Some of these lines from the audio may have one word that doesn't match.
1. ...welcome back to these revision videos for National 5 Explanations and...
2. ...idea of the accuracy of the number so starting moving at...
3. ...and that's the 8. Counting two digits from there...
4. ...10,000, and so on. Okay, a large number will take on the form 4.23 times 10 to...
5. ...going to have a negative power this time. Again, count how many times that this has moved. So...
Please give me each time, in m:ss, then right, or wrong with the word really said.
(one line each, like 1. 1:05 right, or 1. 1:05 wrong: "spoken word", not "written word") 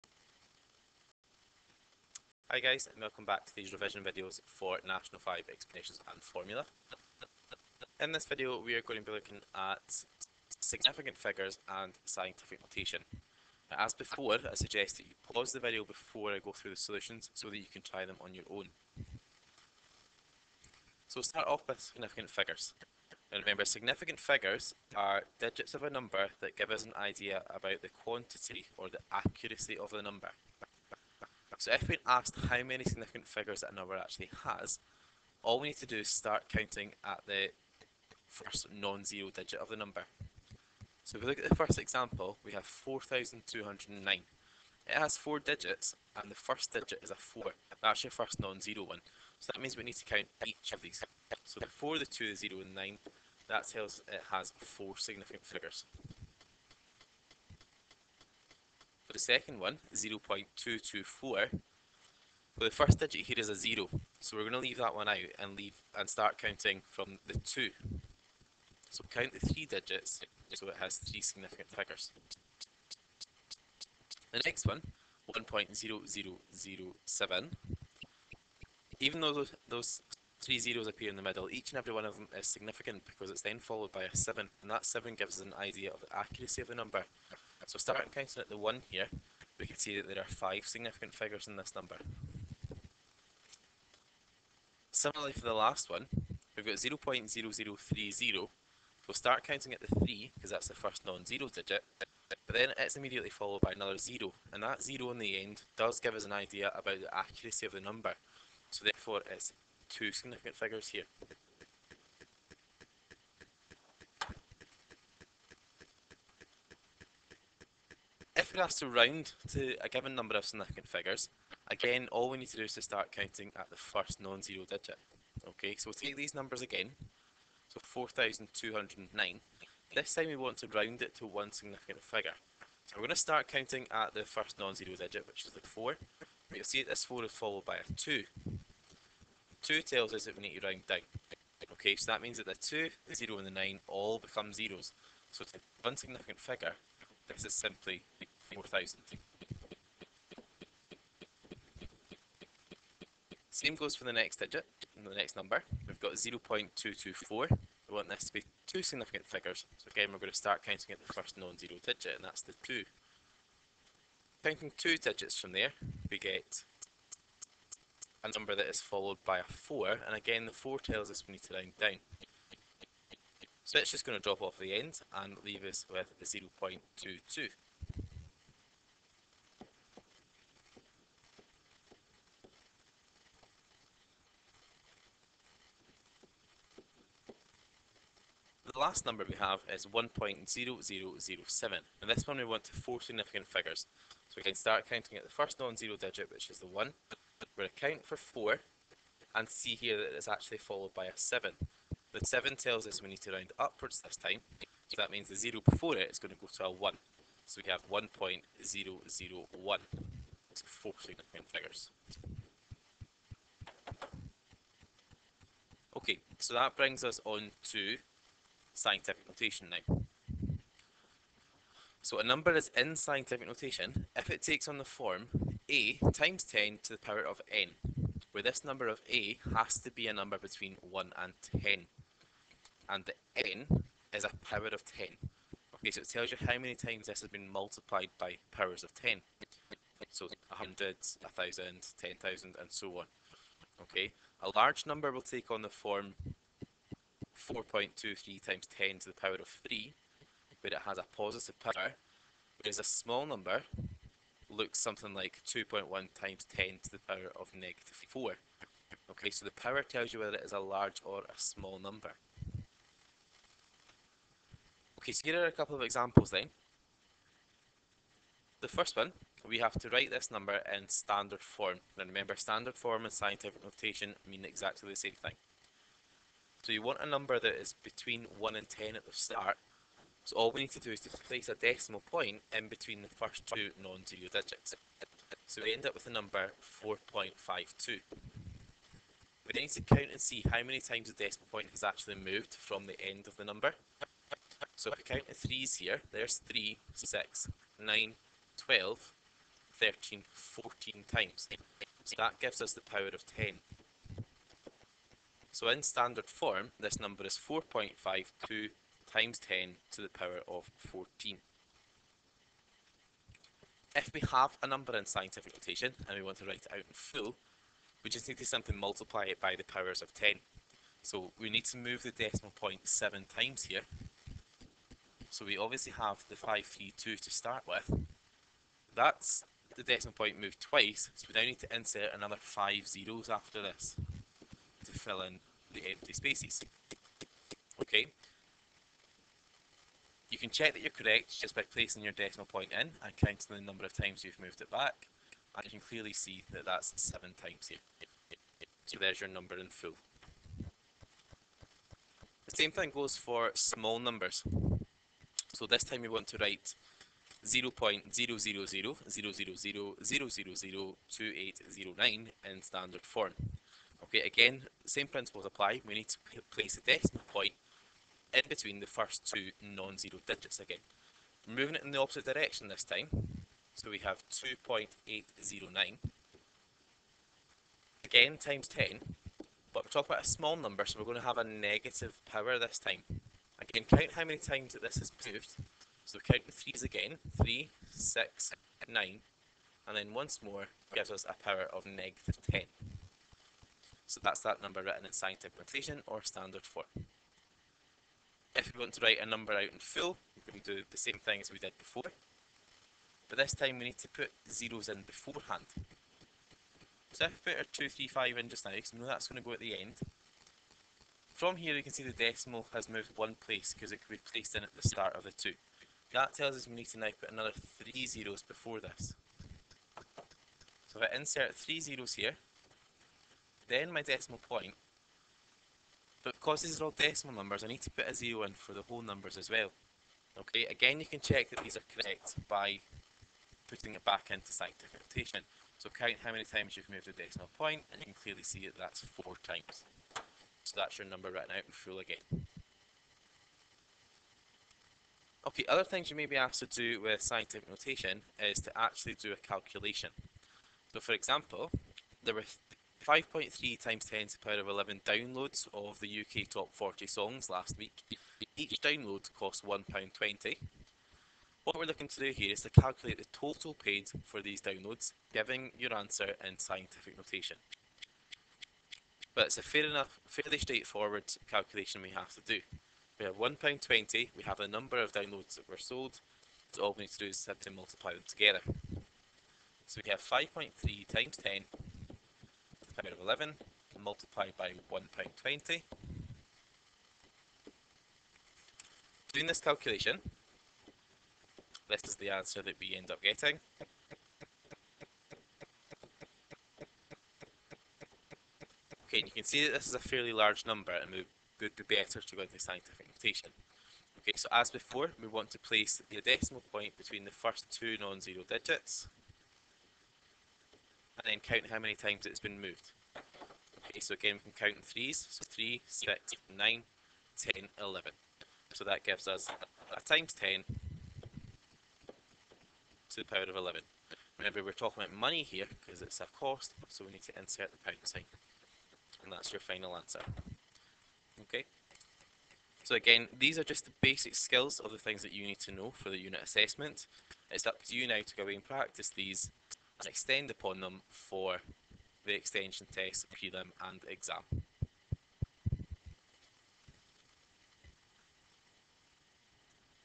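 1. 0:02 right
2. 1:25 wrong: "counting", not "moving"
3. 2:42 wrong: "2", not "8"
4. 4:02 right
5. 6:21 right.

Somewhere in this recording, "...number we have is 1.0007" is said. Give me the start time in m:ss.
3:09.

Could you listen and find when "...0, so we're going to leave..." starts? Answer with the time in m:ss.
1:03.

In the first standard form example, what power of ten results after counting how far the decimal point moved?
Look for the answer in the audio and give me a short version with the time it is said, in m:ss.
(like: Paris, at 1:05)
14, at 5:09.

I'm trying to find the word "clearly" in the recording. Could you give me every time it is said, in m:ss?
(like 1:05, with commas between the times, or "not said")
5:45, 7:18.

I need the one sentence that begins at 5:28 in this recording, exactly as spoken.
That's the decimal point moved twice, so we now need to insert another 5 zeros after this fill in the empty spaces.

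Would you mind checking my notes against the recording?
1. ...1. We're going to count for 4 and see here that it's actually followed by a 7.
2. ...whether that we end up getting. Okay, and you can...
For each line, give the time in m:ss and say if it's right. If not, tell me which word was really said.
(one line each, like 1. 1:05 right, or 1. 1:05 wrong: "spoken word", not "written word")
1. 3:16 right
2. 8:12 wrong: "answer", not "whether".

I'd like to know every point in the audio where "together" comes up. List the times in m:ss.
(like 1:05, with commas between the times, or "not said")
7:58.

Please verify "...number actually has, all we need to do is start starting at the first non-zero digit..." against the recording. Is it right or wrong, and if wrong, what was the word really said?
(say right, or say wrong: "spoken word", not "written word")
wrong: "counting", not "starting".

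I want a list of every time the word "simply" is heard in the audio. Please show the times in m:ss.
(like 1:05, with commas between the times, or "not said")
2:27, 5:18, 7:57.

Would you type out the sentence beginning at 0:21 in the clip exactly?
So start off with significant figures.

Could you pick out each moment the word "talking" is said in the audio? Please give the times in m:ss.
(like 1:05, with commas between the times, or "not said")
6:19, 8:44.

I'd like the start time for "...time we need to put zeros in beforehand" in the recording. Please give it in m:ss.
6:43.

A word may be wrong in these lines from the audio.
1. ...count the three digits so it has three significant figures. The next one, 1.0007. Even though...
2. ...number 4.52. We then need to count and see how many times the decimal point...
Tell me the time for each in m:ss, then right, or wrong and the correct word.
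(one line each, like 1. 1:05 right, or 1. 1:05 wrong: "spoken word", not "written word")
1. 1:09 right
2. 4:46 right.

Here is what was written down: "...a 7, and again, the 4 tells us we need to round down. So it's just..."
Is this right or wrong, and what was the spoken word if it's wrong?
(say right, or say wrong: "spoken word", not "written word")
wrong: "4", not "7".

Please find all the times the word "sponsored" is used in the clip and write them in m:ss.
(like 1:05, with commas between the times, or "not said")
not said.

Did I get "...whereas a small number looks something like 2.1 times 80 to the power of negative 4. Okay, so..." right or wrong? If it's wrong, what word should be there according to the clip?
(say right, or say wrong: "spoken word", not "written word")
wrong: "10", not "80".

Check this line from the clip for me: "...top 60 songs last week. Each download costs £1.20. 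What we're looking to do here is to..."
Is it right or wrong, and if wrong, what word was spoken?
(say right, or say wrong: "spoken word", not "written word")
wrong: "40", not "60".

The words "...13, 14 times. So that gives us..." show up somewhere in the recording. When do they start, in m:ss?
4:59.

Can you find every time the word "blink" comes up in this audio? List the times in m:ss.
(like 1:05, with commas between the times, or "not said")
not said.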